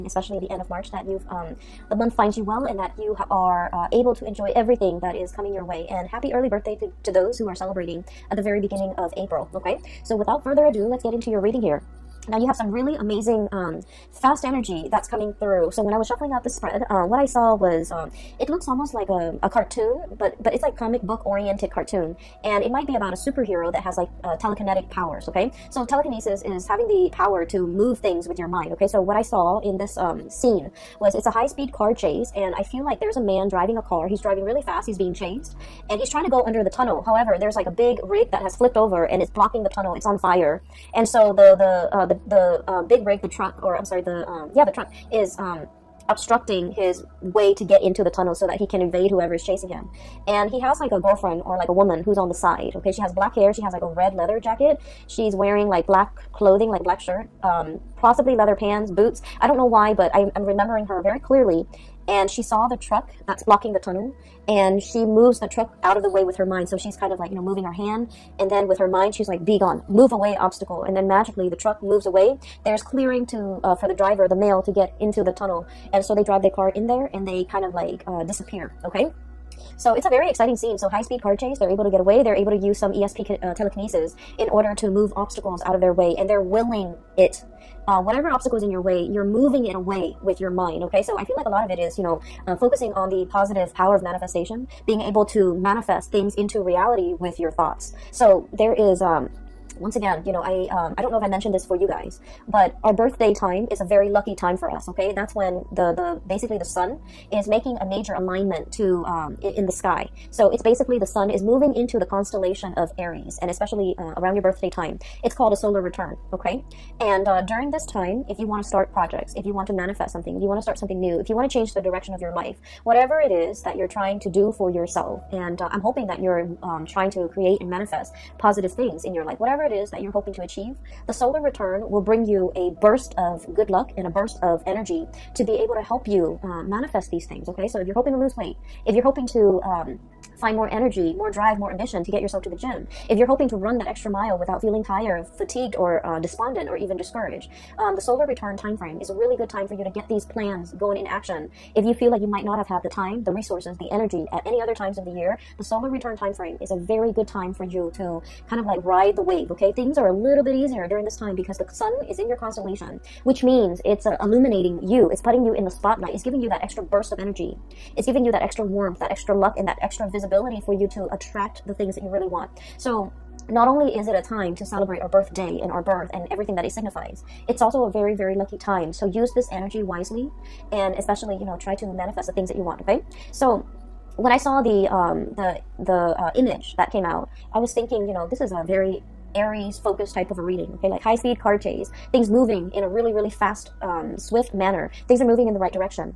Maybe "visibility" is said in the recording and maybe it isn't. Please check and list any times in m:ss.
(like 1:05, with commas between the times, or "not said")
2:50.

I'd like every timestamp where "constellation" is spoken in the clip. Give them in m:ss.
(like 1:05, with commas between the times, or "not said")
1:52, 2:42.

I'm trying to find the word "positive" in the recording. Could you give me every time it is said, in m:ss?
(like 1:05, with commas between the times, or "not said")
1:33, 2:08.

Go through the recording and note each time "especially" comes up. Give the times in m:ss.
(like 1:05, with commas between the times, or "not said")
0:00, 1:53, 3:00.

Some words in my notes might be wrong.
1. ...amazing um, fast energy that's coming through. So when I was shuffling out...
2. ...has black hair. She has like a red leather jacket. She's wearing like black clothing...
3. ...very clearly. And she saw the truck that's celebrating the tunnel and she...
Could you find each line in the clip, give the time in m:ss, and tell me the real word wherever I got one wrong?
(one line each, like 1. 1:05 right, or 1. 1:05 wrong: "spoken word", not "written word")
1. 0:12 right
2. 0:53 right
3. 1:01 wrong: "blocking", not "celebrating".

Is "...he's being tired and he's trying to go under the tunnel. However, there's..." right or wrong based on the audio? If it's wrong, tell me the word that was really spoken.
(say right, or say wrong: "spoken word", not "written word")
wrong: "chased", not "tired".